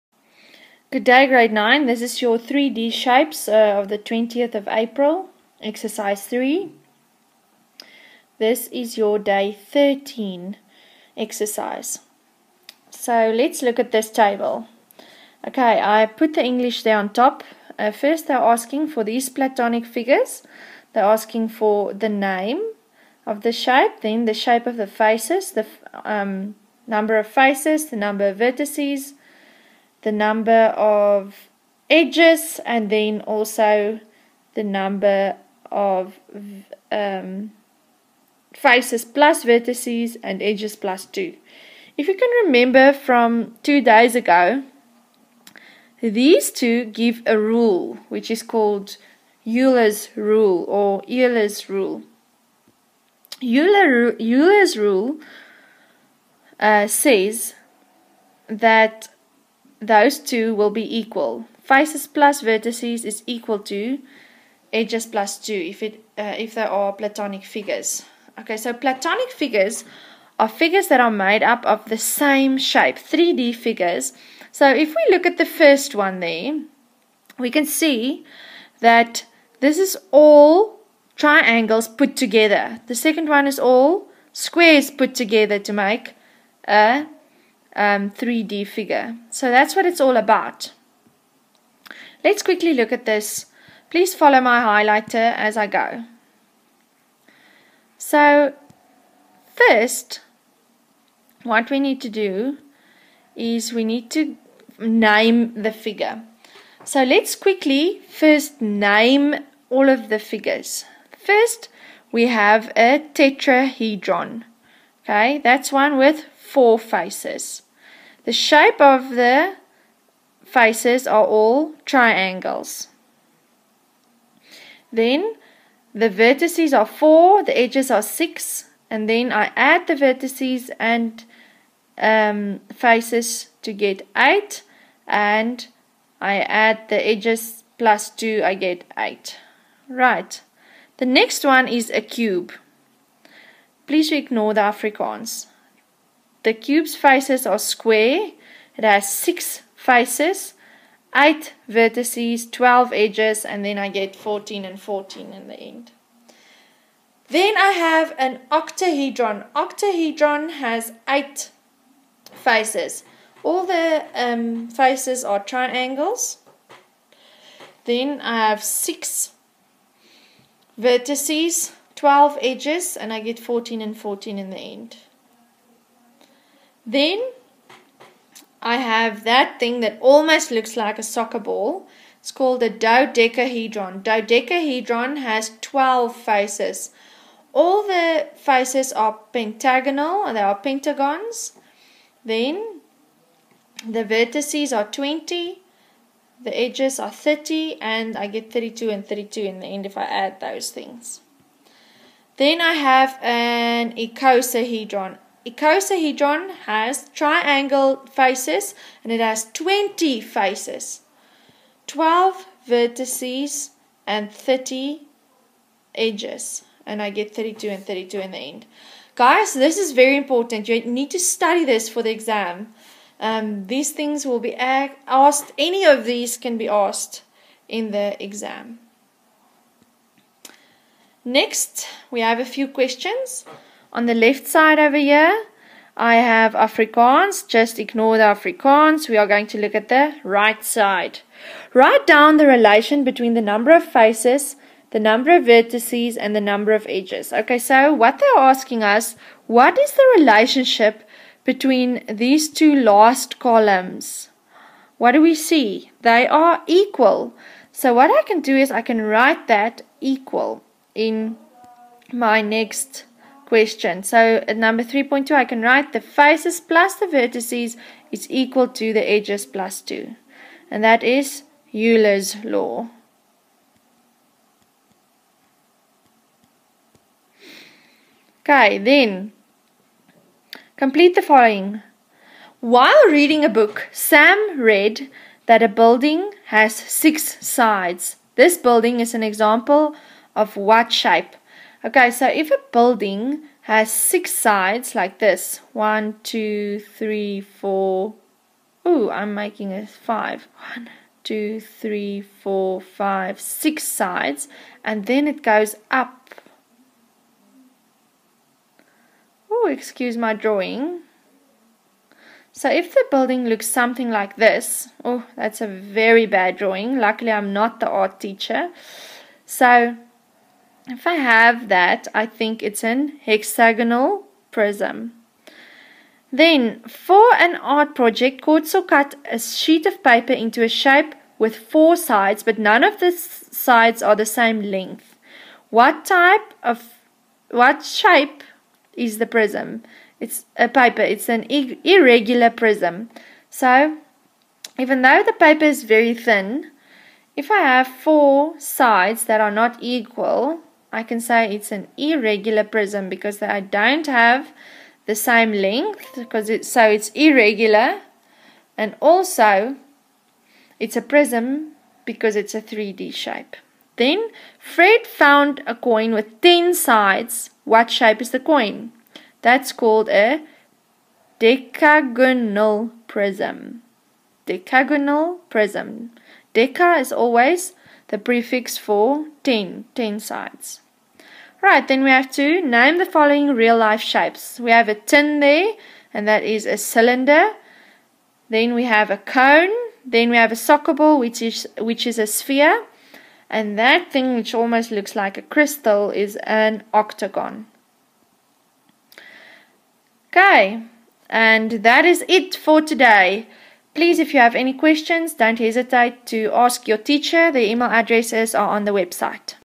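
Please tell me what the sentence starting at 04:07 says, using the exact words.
Okay, so what they're asking us, what is the relationship between these two last columns?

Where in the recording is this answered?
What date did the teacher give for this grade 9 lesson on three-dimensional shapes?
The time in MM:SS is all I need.
00:03.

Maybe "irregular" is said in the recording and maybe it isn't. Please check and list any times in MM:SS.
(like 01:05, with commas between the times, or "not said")
05:41, 05:51, 05:57.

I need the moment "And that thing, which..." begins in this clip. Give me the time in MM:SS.
06:33.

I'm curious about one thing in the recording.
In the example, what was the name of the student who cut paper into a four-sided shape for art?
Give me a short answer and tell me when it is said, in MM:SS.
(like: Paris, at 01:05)
Khotso, at 05:28.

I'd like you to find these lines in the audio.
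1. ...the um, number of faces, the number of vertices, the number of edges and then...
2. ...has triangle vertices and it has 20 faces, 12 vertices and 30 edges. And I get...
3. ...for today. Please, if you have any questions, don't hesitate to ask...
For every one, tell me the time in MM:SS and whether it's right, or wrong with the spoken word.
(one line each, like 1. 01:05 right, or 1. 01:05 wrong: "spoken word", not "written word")
1. 00:25 right
2. 03:26 wrong: "faces", not "vertices"
3. 06:42 right.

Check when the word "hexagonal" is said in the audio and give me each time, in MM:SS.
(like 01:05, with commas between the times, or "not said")
05:23.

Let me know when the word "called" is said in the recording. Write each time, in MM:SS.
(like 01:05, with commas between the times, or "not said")
00:48, 03:02, 06:09.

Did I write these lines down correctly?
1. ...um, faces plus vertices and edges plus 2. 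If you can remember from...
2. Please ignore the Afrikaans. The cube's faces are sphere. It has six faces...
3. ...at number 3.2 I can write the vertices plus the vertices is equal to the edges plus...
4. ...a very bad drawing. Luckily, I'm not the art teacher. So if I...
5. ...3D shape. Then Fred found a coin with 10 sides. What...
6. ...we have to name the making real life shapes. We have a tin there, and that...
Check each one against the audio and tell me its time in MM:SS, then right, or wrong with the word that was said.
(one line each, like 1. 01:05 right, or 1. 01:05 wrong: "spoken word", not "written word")
1. 00:36 right
2. 02:23 wrong: "square", not "sphere"
3. 04:24 wrong: "faces", not "vertices"
4. 05:15 right
5. 06:02 right
6. 06:22 wrong: "following", not "making".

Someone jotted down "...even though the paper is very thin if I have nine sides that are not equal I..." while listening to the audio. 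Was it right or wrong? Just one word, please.
wrong.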